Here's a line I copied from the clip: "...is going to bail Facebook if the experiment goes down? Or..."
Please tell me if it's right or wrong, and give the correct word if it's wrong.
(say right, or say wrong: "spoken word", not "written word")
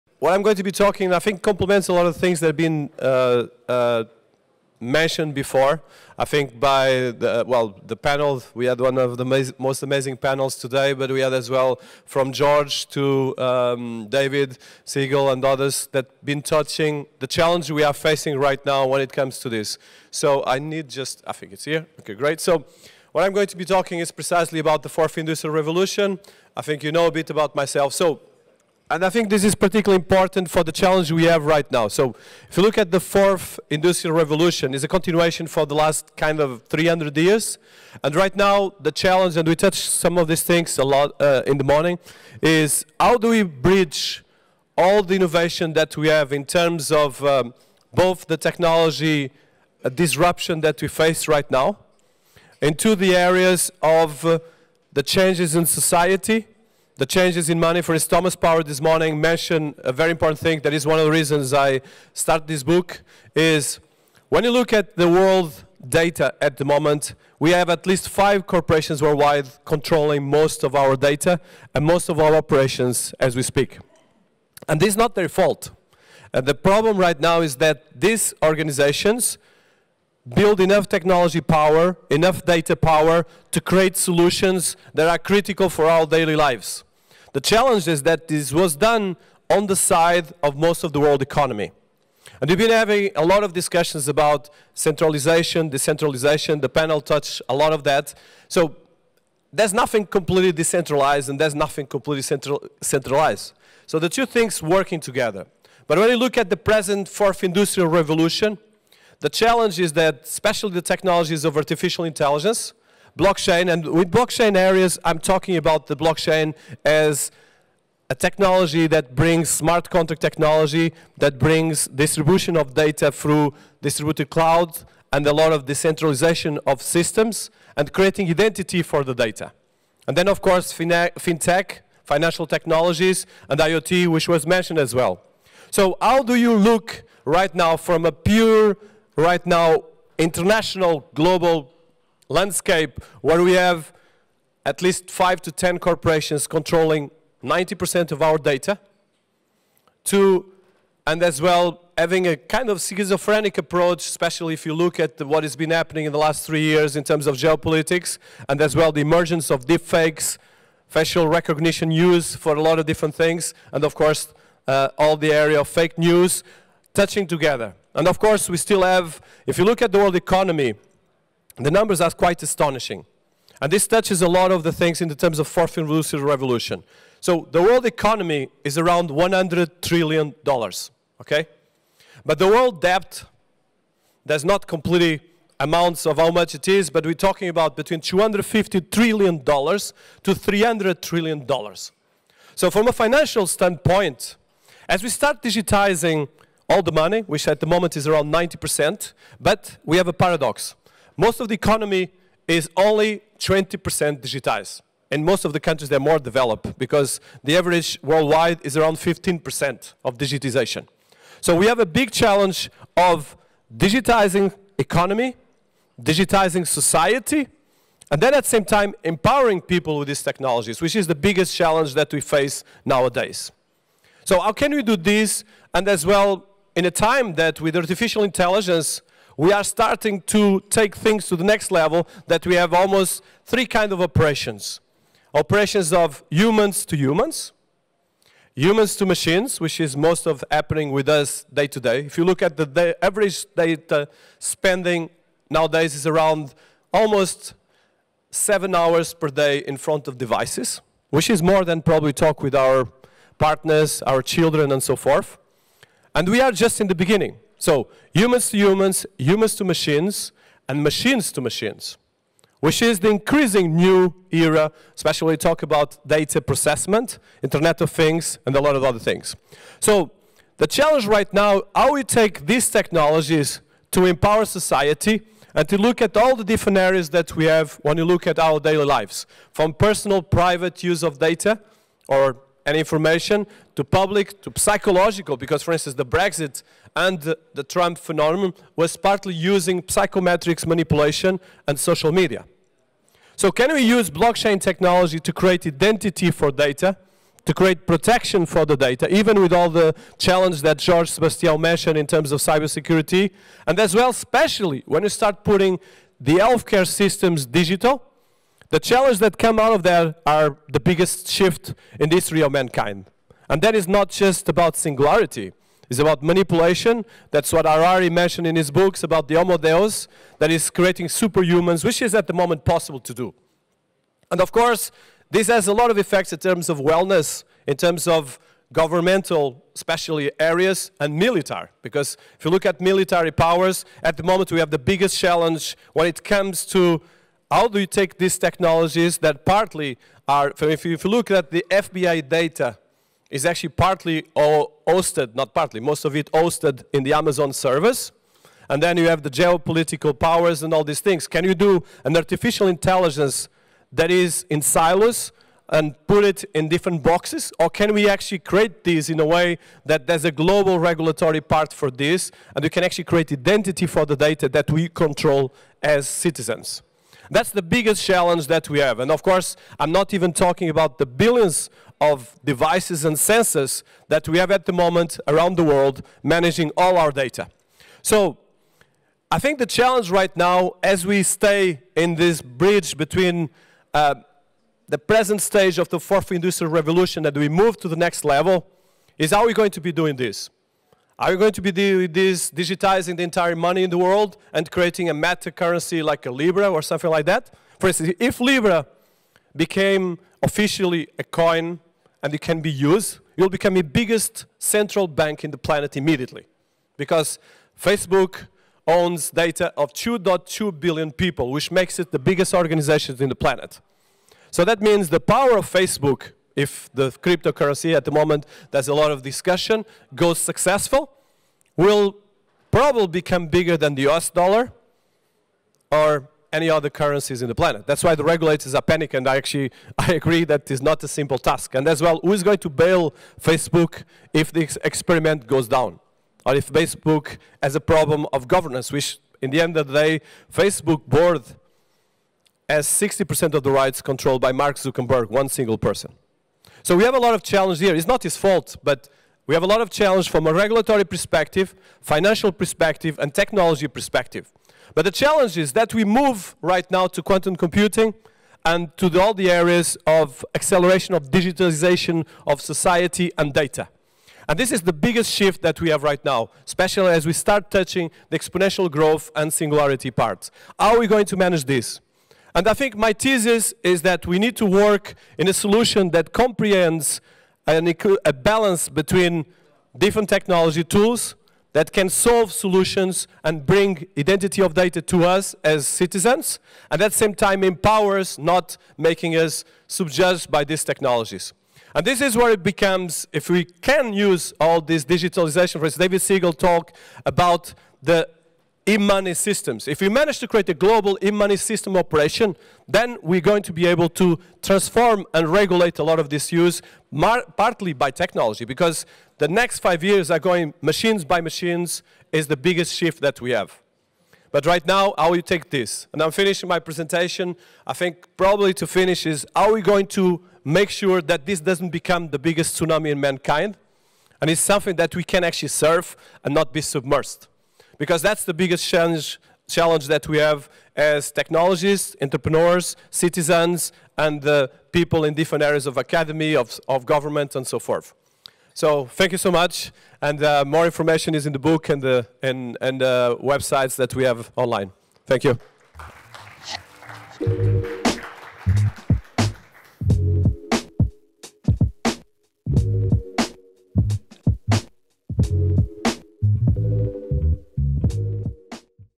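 right.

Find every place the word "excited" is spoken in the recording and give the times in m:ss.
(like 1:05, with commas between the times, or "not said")
not said.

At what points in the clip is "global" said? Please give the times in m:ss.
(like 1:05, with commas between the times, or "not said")
2:21, 6:00, 8:20.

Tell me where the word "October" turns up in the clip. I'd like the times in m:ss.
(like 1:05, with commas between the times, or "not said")
not said.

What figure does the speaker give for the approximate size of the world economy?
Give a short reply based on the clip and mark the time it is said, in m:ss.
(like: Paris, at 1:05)
100 trillion dollars, at 2:59.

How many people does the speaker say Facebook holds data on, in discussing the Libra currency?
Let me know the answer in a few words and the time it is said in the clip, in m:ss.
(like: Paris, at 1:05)
2.2 billion, at 6:49.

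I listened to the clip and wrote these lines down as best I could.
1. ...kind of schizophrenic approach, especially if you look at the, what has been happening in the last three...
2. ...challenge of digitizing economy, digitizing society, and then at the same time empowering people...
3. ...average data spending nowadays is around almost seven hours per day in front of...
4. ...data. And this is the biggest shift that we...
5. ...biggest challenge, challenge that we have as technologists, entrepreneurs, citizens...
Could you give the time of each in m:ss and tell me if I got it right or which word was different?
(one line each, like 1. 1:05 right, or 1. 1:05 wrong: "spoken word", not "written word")
1. 2:32 right
2. 3:32 right
3. 4:03 right
4. 7:43 right
5. 8:48 right.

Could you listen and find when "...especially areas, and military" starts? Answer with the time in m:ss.
5:29.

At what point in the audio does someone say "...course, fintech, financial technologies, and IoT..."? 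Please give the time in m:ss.
2:10.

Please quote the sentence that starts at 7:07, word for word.
That's why the regulators are panicked.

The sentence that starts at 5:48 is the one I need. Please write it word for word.
And then you have the geopolitical powers and all these things.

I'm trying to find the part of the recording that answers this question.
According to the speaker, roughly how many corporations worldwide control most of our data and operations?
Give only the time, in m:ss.
1:08.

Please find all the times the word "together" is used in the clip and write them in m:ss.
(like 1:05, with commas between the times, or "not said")
1:44, 2:47.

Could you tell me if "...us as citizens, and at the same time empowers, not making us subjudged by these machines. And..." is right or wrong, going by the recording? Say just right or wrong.
wrong.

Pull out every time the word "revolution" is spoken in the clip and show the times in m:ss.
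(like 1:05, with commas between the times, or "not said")
0:25, 0:34, 1:47, 2:56, 6:26.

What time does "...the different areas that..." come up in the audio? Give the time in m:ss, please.
4:36.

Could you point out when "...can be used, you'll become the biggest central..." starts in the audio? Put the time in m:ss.
6:42.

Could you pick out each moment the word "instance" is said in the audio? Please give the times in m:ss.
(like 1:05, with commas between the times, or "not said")
0:57, 4:45, 6:37, 8:15.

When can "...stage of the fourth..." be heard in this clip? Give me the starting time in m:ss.
6:25.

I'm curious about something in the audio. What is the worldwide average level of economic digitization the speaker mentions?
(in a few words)
15%.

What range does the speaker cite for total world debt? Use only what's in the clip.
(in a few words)
250 to 300 trillion dollars.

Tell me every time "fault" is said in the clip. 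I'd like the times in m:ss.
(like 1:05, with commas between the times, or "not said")
1:15, 7:28.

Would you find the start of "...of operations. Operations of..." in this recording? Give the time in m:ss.
3:53.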